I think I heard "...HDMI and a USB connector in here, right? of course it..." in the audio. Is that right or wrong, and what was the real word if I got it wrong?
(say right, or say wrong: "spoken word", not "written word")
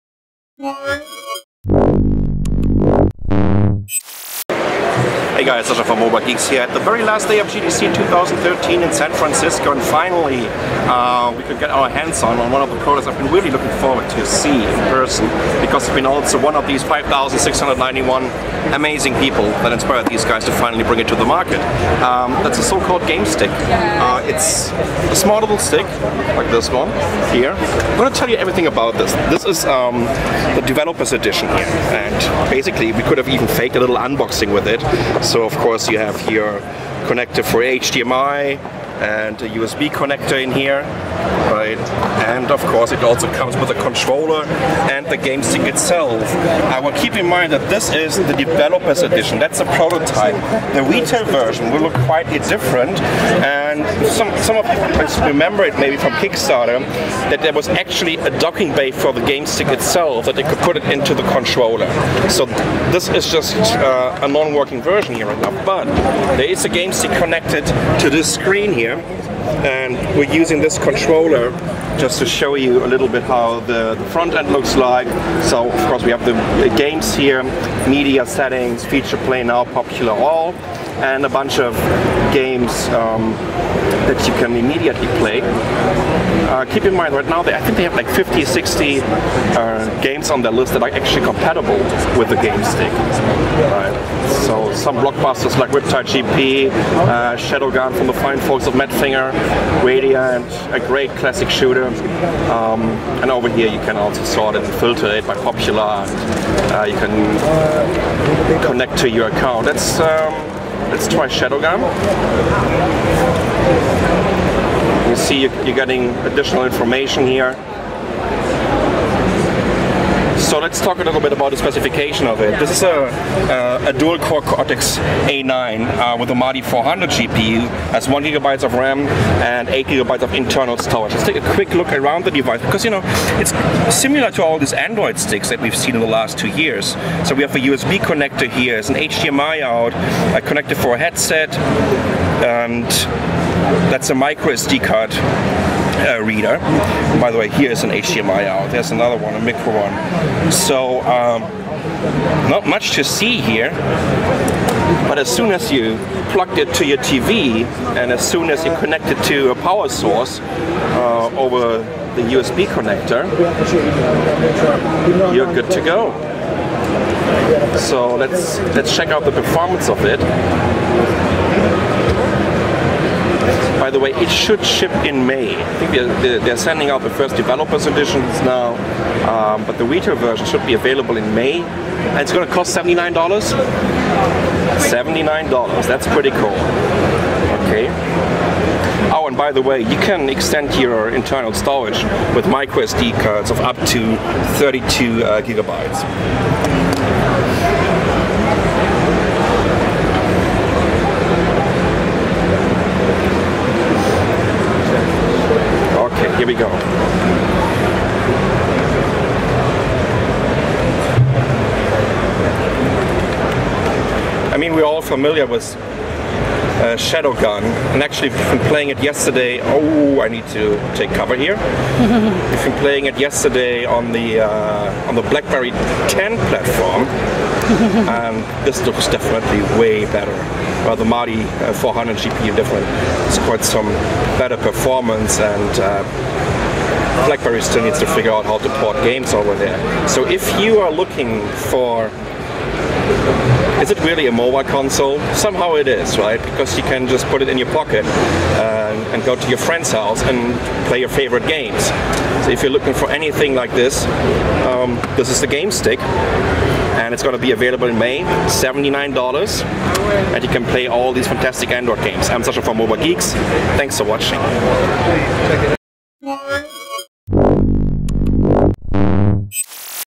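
right.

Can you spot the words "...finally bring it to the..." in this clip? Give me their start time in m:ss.
0:20.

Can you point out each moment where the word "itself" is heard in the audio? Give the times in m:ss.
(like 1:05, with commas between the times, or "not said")
0:45, 0:59.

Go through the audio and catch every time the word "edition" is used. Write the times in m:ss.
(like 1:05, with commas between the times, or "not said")
0:31, 0:49, 2:57.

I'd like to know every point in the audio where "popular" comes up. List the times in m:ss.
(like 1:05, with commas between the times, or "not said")
1:19, 1:45.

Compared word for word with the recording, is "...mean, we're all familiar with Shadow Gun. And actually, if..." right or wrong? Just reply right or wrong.
right.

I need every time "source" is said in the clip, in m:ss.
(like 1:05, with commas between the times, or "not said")
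2:39.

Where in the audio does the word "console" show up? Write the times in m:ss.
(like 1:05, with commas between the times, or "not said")
4:04.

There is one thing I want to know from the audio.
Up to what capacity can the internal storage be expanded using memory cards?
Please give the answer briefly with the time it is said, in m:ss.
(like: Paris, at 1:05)
32 gigabytes, at 3:14.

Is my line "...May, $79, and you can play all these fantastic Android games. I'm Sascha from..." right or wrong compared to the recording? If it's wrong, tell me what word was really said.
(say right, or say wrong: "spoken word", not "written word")
right.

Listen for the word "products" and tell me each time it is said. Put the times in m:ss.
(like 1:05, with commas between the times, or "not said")
0:12.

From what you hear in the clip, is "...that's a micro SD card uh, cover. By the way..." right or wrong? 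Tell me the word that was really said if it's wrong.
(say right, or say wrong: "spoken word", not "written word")
wrong: "reader", not "cover".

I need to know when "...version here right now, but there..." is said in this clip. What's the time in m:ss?
1:04.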